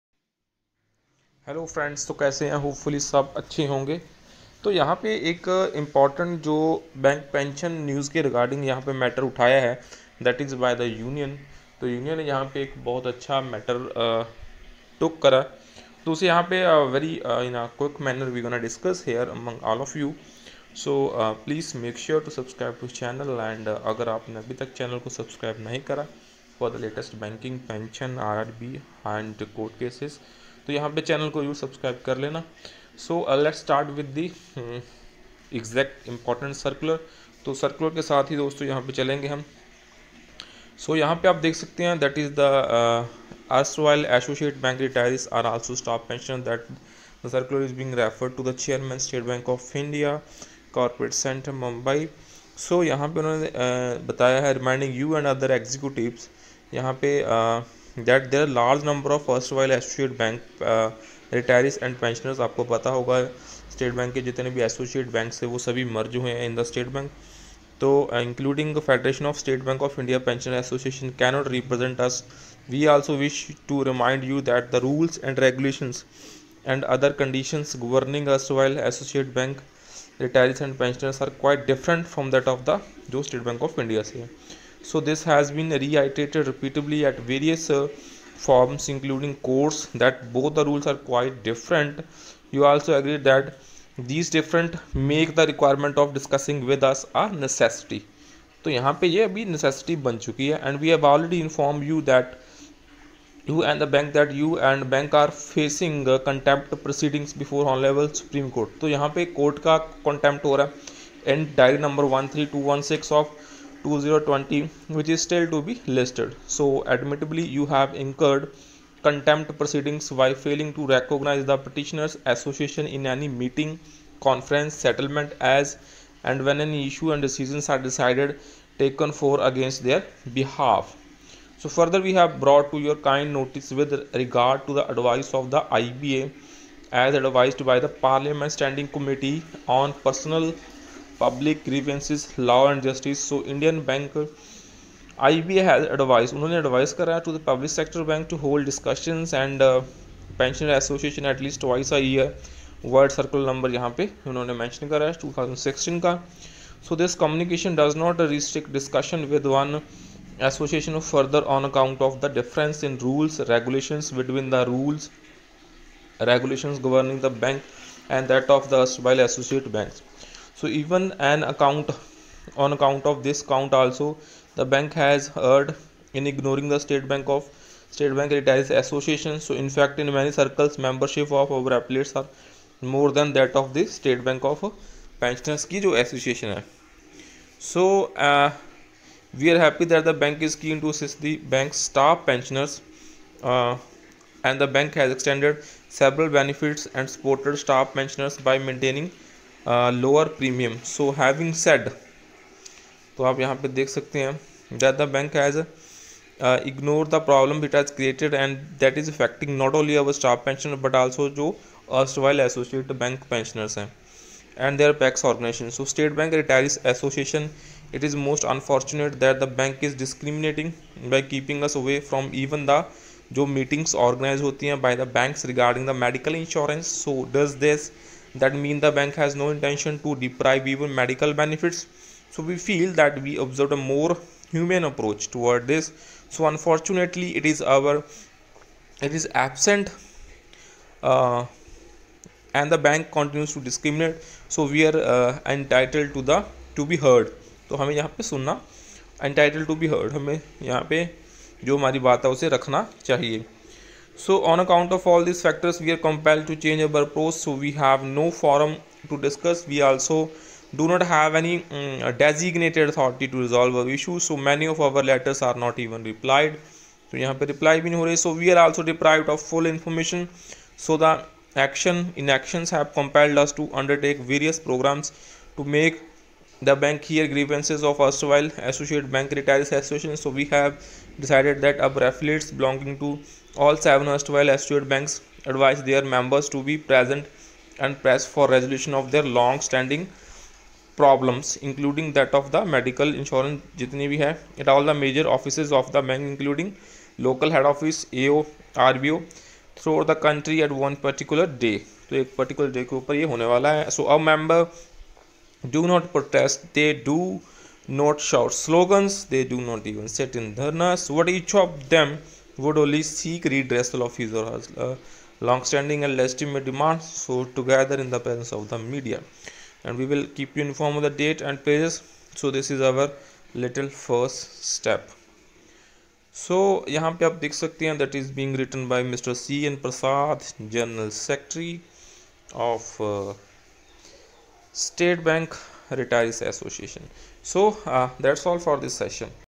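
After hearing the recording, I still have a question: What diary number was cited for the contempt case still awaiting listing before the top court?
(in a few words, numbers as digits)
2020.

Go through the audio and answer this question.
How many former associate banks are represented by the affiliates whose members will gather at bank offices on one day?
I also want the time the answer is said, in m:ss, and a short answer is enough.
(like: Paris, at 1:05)
7, at 4:43.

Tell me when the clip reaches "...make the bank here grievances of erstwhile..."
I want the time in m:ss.
4:35.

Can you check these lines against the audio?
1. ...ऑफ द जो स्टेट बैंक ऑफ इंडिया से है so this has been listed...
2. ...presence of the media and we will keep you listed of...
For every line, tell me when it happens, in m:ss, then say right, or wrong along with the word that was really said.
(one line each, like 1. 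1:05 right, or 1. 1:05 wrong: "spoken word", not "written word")
1. 1:22 wrong: "reiterated", not "listed"
2. 5:18 wrong: "informed", not "listed".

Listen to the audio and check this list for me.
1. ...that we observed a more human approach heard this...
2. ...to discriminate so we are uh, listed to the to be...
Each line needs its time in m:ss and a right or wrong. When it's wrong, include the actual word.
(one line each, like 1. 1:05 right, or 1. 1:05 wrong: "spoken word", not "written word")
1. 3:52 wrong: "toward", not "heard"
2. 4:03 wrong: "entitled", not "listed".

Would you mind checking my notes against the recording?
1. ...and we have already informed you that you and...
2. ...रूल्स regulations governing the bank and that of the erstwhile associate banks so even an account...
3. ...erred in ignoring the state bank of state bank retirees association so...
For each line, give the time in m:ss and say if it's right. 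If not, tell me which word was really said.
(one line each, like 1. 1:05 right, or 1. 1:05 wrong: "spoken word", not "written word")
1. 1:40 right
2. 2:44 right
3. 2:55 right.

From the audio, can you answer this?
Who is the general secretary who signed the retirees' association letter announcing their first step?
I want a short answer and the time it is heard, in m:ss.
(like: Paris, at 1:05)
C N Prasad, at 5:29.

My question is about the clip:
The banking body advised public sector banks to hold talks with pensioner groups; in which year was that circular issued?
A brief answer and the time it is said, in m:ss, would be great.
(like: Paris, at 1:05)
2016, at 2:35.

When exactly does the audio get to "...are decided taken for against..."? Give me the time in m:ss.
2:07.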